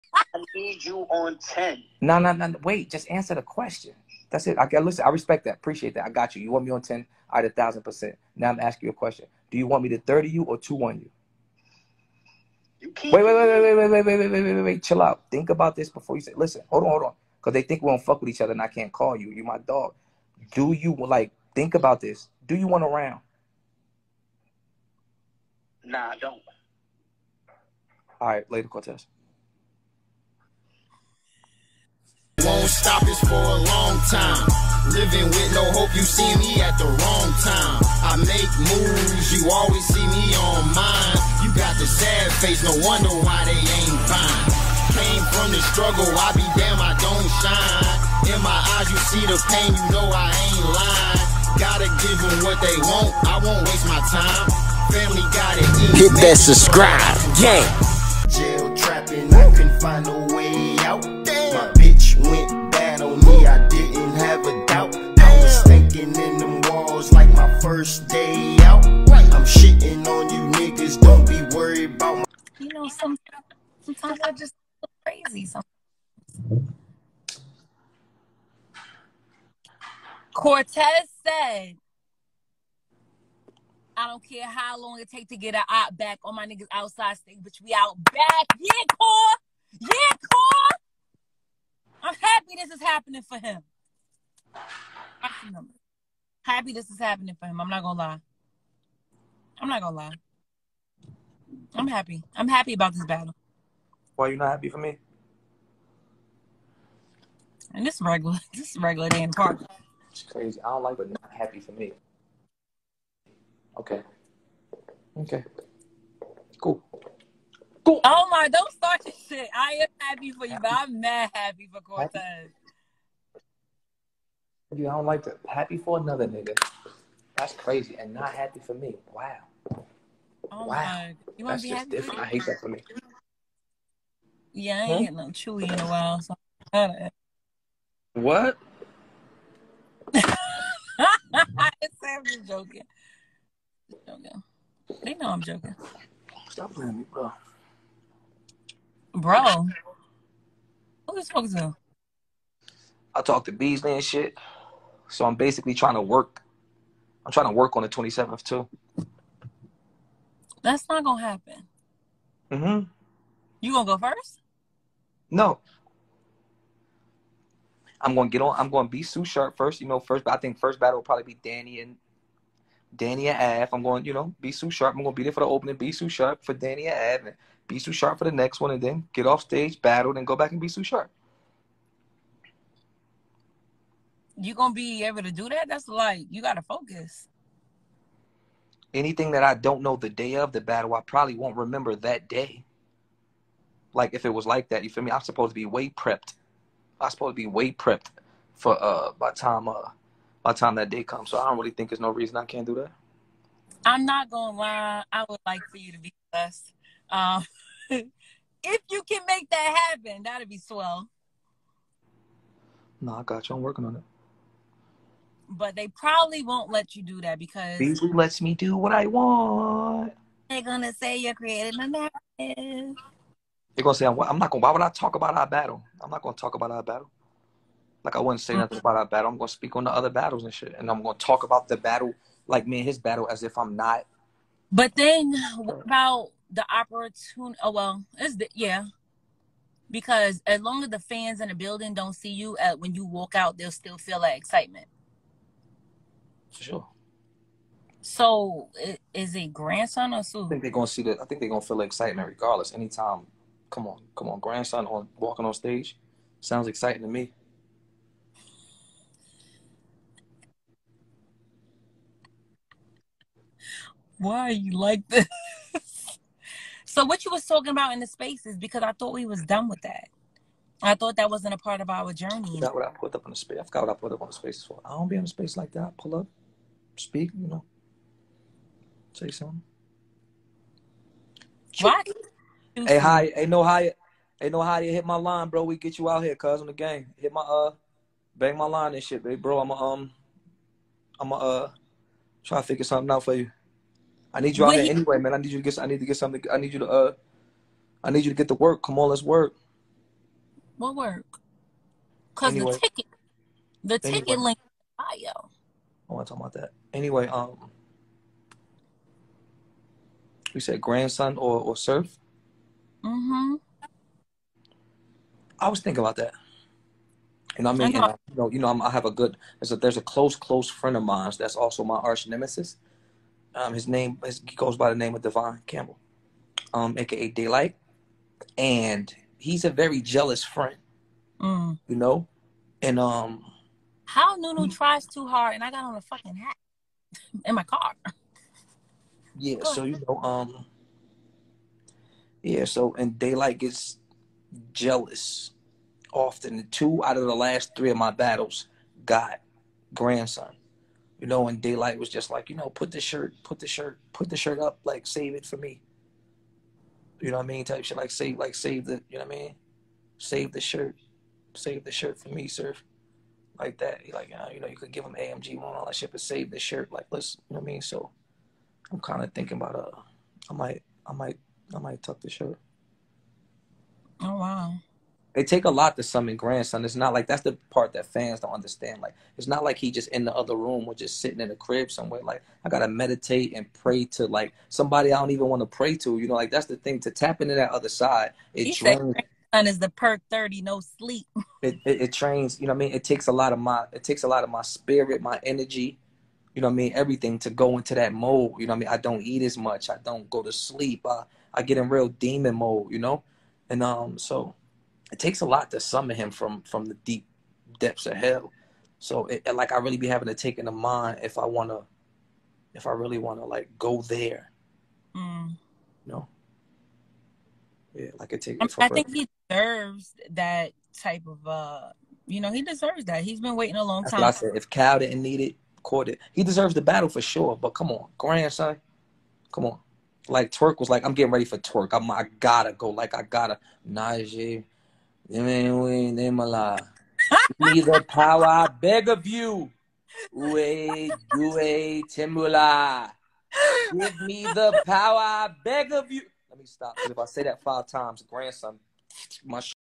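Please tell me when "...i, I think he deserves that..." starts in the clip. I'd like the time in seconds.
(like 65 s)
418 s.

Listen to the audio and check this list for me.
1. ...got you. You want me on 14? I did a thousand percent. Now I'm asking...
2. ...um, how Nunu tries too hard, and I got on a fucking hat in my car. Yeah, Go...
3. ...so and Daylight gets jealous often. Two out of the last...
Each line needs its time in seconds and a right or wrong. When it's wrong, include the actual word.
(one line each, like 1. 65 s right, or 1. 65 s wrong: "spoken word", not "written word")
1. 6 s wrong: "10", not "14"
2. 332 s right
3. 342 s right.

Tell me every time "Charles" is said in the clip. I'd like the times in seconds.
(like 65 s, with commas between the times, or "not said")
not said.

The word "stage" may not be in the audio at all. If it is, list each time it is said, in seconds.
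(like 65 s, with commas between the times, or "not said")
87 s, 179 s, 255 s.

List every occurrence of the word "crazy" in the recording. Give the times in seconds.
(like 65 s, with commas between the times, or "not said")
75 s, 110 s, 127 s.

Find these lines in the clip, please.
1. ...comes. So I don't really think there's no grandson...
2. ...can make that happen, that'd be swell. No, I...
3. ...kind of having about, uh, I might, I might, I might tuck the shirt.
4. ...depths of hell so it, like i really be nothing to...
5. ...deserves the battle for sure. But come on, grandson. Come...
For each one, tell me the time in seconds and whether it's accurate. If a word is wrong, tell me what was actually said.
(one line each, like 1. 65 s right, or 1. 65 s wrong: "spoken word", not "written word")
1. 201 s wrong: "reason", not "grandson"
2. 209 s right
3. 368 s wrong: "thinking", not "having"
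4. 407 s wrong: "having", not "nothing"
5. 426 s right.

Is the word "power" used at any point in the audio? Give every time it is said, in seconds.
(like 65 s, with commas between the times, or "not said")
438 s, 444 s.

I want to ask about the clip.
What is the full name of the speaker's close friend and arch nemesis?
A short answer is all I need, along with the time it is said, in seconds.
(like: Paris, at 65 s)
Devon Campbell, at 325 s.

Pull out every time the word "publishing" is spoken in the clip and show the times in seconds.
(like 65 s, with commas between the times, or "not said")
not said.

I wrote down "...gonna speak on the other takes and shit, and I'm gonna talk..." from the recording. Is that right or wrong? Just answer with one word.
wrong.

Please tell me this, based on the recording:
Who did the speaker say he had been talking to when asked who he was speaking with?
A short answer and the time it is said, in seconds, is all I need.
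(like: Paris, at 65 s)
Beasley, at 153 s.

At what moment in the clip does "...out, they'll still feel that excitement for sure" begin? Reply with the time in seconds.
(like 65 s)
243 s.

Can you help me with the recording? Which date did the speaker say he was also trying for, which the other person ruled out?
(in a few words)
the 27th.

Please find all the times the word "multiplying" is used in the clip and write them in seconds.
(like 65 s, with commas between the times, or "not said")
not said.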